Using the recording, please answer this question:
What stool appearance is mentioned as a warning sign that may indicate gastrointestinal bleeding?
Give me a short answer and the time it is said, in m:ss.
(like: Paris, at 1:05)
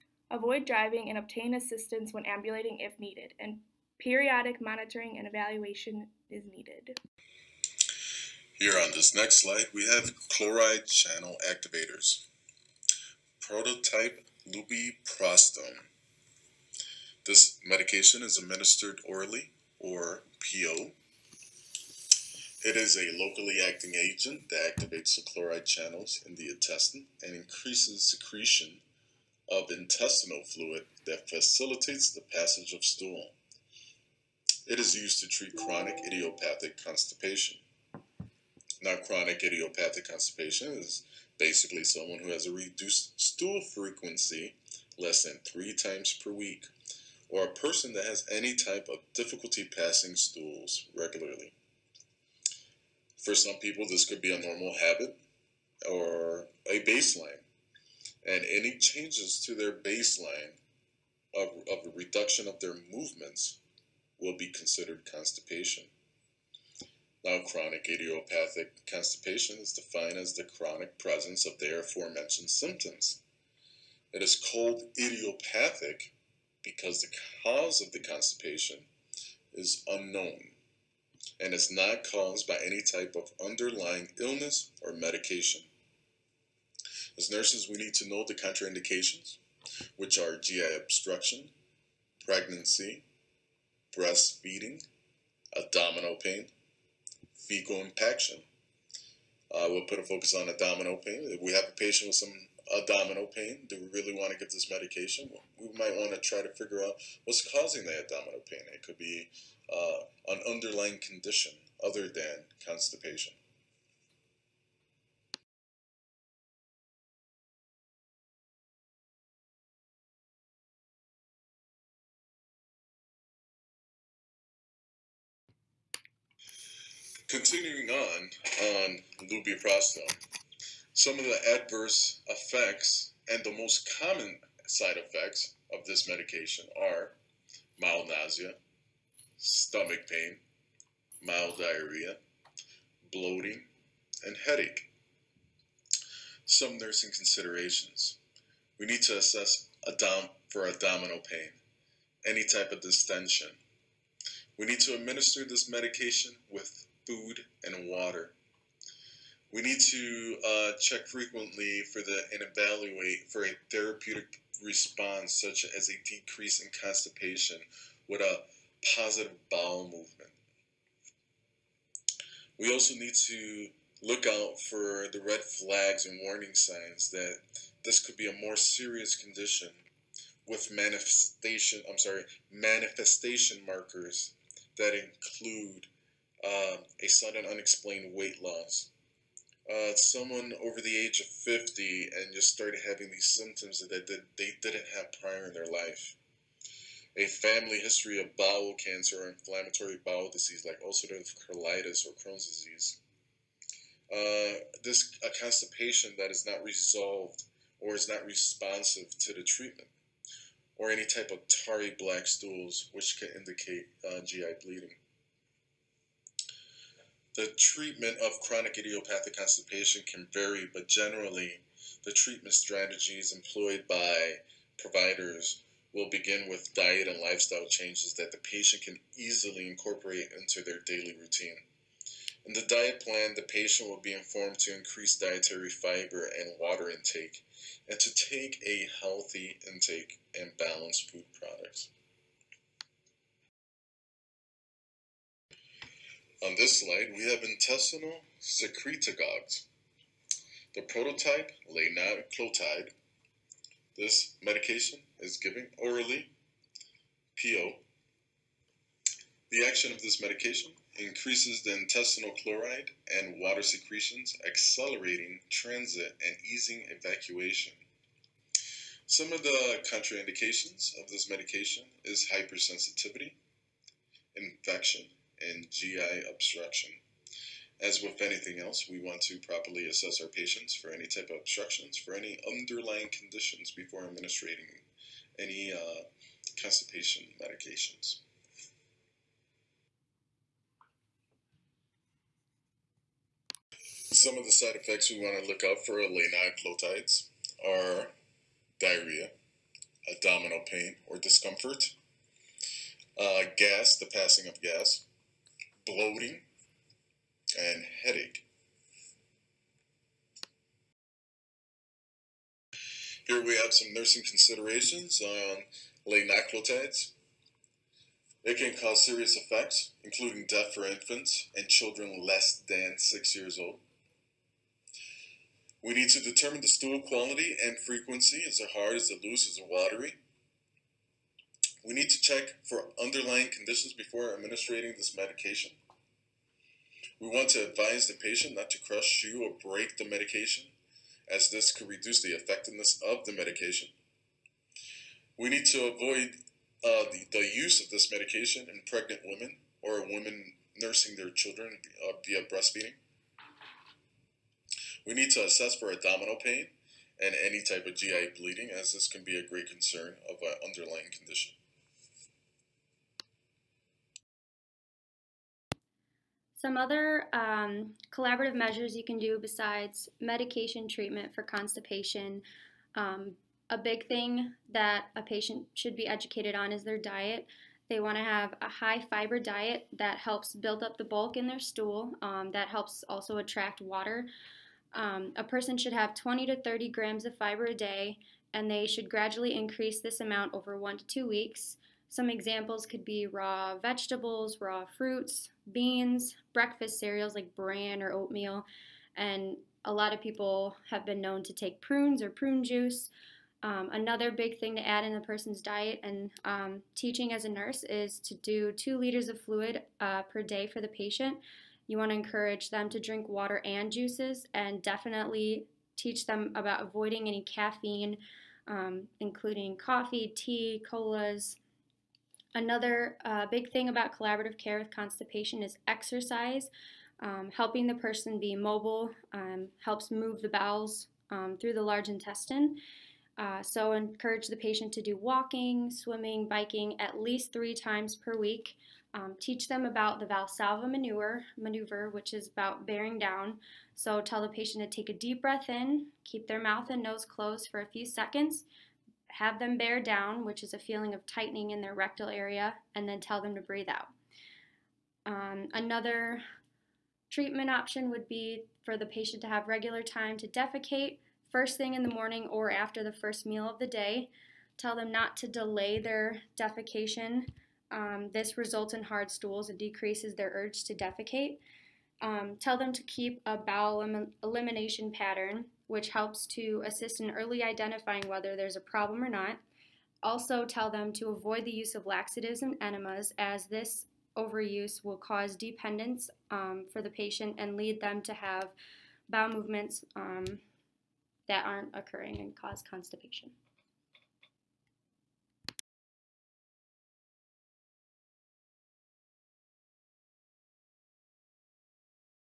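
tarry black stools, at 3:31.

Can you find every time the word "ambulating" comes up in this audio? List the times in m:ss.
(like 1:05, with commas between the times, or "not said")
0:02.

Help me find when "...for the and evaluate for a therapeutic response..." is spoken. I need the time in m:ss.
2:41.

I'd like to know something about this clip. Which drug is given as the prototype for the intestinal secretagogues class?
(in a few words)
linaclotide.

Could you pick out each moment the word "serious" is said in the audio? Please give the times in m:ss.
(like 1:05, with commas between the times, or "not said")
2:58, 5:19.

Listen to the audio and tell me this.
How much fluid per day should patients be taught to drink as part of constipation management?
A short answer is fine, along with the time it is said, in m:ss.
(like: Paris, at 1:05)
2 liters, at 6:48.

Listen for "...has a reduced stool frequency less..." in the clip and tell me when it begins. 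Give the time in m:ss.
0:42.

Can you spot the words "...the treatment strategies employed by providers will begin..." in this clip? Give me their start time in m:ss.
3:42.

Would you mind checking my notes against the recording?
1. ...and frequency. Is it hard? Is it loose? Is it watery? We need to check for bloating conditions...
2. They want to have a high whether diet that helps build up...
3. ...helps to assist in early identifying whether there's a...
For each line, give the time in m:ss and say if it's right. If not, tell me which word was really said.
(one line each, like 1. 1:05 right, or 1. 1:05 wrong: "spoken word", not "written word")
1. 5:27 wrong: "underlying", not "bloating"
2. 6:17 wrong: "fiber", not "whether"
3. 7:56 right.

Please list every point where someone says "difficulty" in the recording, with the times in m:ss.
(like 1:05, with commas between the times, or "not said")
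0:49.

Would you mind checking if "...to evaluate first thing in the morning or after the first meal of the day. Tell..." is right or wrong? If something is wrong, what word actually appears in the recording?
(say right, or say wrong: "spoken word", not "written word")
wrong: "defecate", not "evaluate".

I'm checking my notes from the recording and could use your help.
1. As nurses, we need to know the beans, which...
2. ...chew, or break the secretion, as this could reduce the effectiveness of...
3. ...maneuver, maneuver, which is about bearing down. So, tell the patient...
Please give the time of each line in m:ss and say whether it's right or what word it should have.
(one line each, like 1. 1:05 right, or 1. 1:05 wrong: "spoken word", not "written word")
1. 1:27 wrong: "contraindications", not "beans"
2. 5:39 wrong: "medication", not "secretion"
3. 7:20 right.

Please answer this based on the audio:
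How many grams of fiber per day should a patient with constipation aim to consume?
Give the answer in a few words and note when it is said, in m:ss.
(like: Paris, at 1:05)
20 to 30 grams, at 6:26.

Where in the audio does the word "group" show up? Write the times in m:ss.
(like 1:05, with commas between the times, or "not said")
not said.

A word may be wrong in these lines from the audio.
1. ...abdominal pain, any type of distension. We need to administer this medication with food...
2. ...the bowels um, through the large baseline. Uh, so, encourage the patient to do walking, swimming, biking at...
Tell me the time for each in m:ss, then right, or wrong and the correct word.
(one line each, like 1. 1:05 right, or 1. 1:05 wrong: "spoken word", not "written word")
1. 2:30 right
2. 7:10 wrong: "intestine", not "baseline".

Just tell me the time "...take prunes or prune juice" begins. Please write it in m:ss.
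6:41.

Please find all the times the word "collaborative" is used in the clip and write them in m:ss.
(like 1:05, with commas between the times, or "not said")
6:08, 7:04.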